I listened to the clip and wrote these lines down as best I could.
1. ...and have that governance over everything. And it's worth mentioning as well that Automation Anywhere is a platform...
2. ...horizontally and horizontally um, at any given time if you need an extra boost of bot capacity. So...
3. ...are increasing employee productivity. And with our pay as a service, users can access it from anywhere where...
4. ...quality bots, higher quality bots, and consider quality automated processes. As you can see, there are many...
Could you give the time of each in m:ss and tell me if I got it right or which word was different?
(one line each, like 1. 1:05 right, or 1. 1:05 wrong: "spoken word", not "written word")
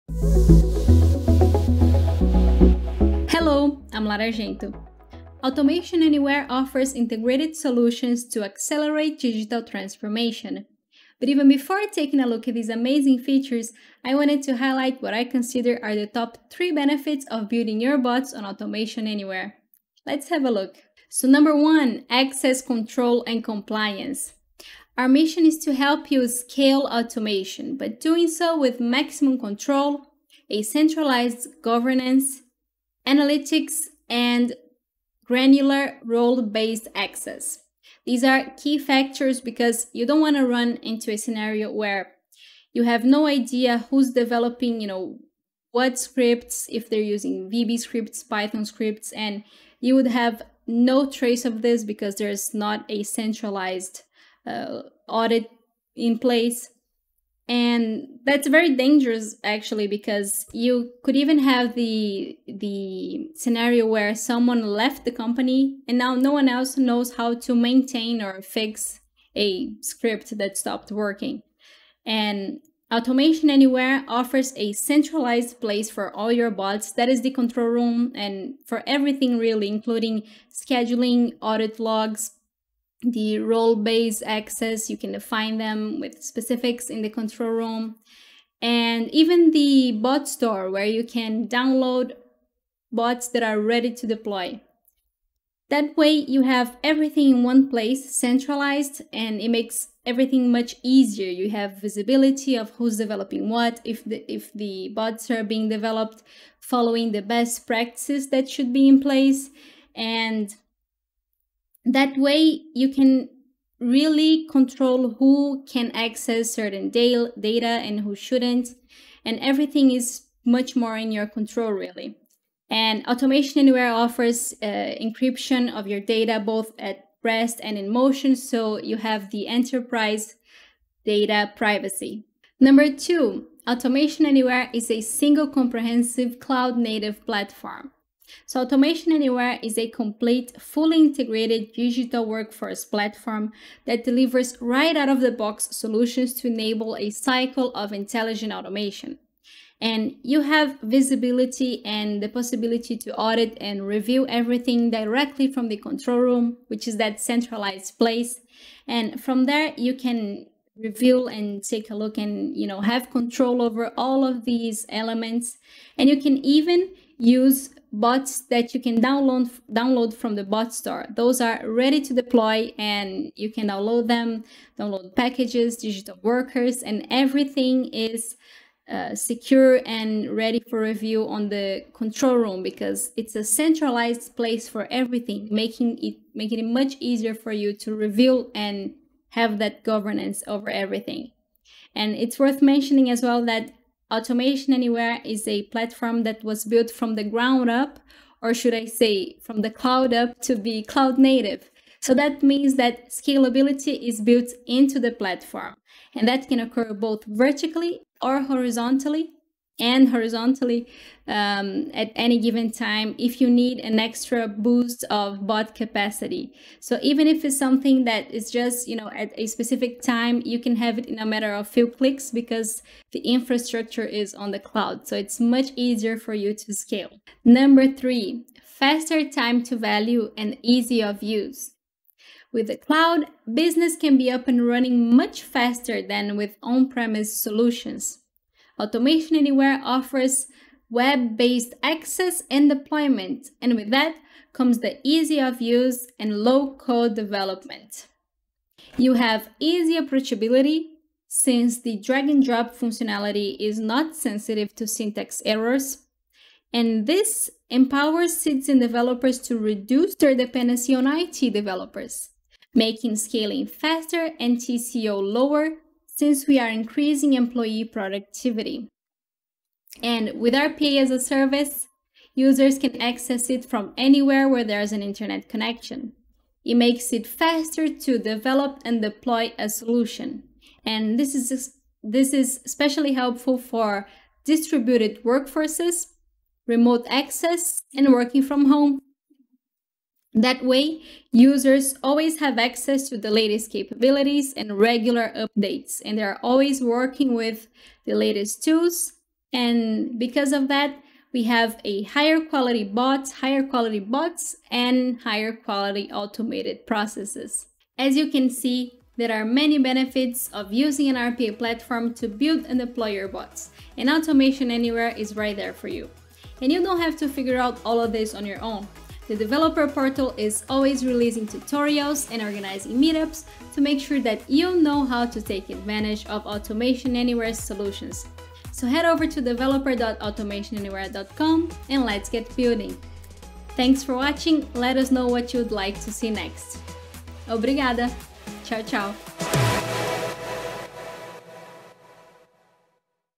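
1. 3:08 right
2. 3:28 right
3. 4:26 right
4. 5:02 wrong: "higher", not "consider".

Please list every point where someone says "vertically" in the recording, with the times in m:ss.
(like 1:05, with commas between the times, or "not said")
3:27.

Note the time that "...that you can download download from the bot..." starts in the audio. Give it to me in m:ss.
2:48.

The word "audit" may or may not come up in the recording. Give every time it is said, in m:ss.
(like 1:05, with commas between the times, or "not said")
0:55, 1:21, 2:33.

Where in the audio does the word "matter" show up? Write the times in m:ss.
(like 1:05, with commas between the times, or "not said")
3:41.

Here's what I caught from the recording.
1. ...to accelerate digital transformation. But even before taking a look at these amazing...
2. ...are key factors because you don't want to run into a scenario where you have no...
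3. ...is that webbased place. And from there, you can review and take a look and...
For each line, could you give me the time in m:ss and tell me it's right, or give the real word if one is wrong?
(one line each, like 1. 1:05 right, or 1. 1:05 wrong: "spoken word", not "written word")
1. 0:08 right
2. 0:38 right
3. 2:36 wrong: "centralized", not "webbased".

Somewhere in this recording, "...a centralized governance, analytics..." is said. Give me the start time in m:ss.
0:30.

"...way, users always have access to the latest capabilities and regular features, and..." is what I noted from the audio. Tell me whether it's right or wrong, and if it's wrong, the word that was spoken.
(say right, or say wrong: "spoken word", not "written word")
wrong: "updates", not "features".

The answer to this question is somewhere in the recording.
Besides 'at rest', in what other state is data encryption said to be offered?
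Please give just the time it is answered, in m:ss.
2:07.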